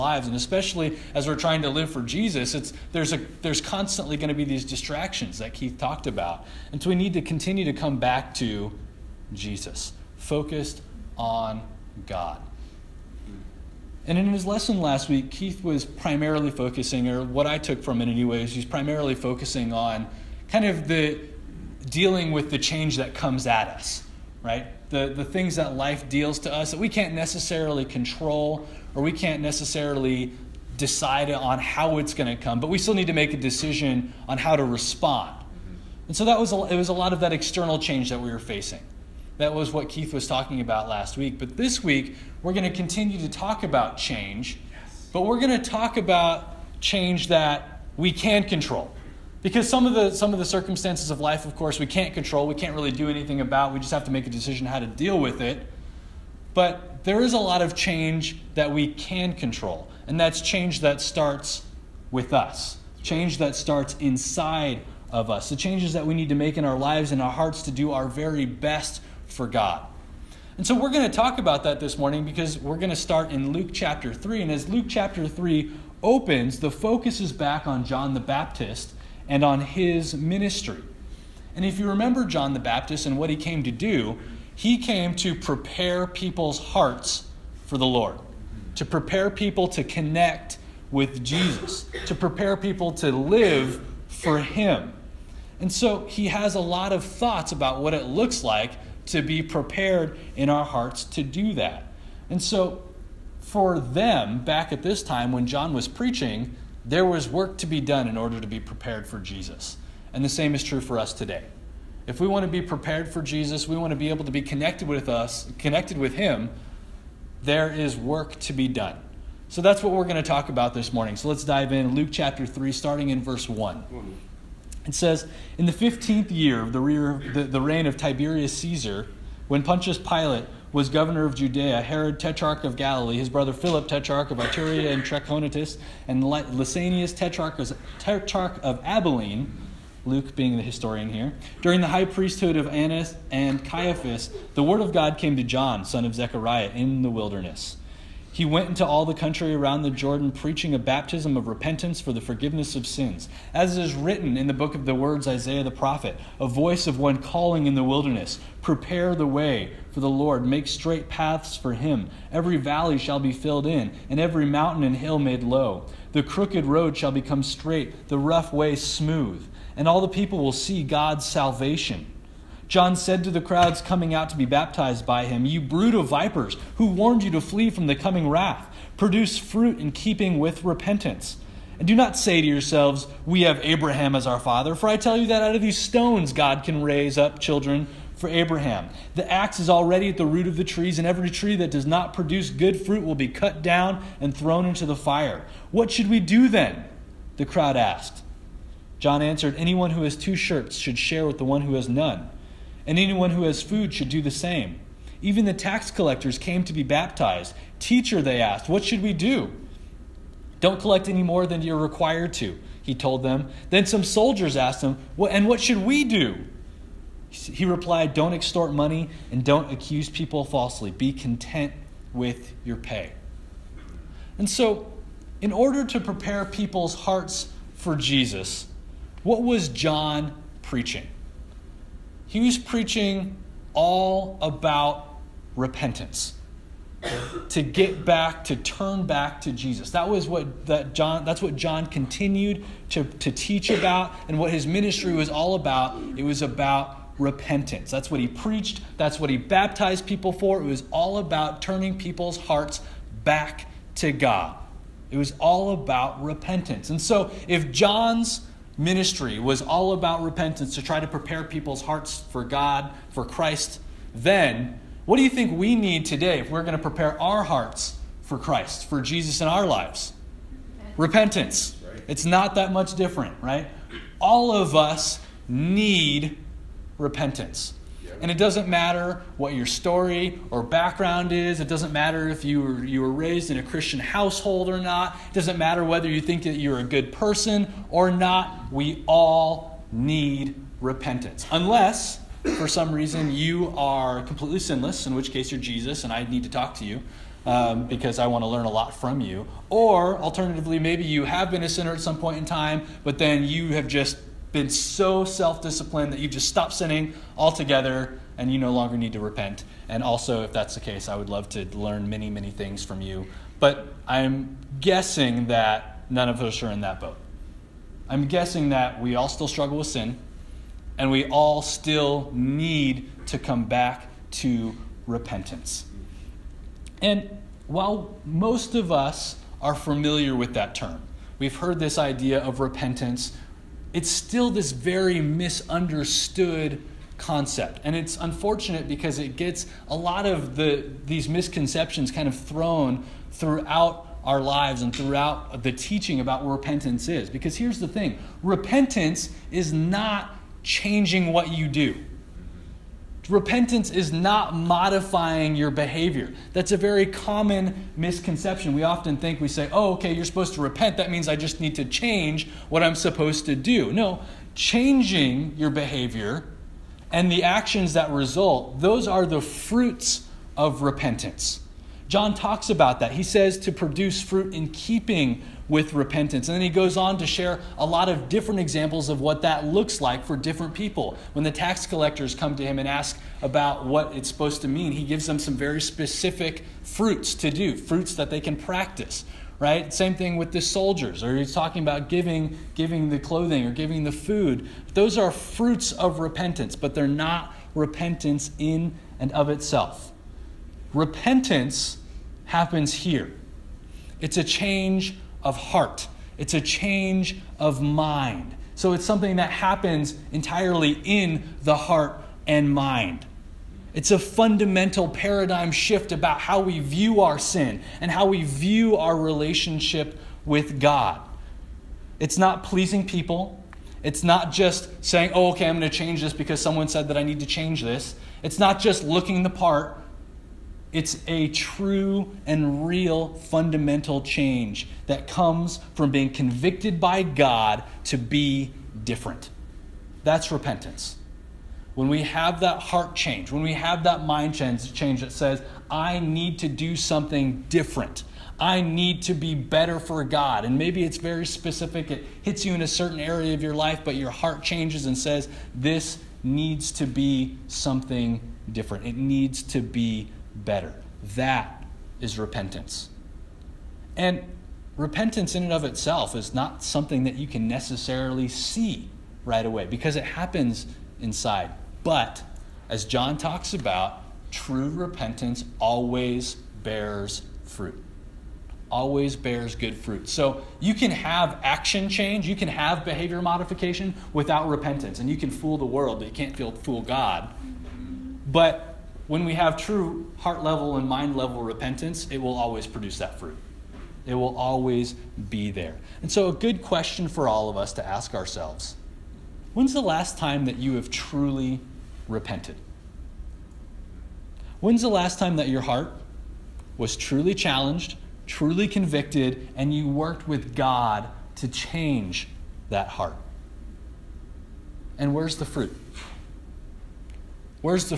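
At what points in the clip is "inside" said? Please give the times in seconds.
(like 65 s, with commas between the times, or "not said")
64 s, 471 s.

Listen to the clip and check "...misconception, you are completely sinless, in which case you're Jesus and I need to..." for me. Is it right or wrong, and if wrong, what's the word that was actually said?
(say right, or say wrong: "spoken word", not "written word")
wrong: "reason", not "misconception".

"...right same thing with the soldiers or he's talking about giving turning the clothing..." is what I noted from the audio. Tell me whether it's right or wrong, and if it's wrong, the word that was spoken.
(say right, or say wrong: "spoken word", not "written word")
wrong: "giving", not "turning".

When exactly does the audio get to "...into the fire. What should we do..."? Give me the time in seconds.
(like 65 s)
194 s.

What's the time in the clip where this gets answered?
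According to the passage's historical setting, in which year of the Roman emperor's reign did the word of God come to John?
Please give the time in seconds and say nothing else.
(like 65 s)
125 s.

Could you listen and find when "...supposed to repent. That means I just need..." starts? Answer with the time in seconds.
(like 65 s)
360 s.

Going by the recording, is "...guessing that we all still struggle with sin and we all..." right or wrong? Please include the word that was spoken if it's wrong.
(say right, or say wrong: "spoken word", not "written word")
right.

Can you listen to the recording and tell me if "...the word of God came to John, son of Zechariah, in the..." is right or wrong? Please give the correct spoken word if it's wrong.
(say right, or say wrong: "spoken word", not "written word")
right.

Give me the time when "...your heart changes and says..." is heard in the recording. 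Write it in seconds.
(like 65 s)
454 s.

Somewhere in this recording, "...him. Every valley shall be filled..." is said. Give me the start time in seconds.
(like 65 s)
161 s.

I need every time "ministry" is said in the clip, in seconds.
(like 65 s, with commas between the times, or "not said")
80 s, 244 s, 258 s.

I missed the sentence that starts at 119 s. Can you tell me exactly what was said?
So that's what we're going to talk about this morning.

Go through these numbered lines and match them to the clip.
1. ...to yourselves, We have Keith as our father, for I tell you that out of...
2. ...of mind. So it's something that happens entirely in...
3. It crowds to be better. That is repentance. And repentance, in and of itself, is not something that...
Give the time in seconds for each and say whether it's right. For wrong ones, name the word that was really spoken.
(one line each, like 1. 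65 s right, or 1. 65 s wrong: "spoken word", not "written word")
1. 182 s wrong: "Abraham", not "Keith"
2. 407 s right
3. 459 s wrong: "needs", not "crowds".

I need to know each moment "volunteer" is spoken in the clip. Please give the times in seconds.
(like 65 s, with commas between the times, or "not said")
not said.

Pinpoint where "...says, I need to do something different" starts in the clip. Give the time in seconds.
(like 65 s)
445 s.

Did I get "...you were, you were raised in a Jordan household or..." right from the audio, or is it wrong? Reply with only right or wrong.
wrong.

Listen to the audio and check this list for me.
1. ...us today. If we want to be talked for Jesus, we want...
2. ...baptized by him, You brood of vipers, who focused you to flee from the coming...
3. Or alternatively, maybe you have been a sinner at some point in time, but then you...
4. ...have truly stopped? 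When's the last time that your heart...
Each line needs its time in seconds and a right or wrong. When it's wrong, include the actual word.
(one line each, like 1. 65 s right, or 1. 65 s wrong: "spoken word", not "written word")
1. 110 s wrong: "prepared", not "talked"
2. 174 s wrong: "warned", not "focused"
3. 299 s right
4. 500 s wrong: "repented", not "stopped".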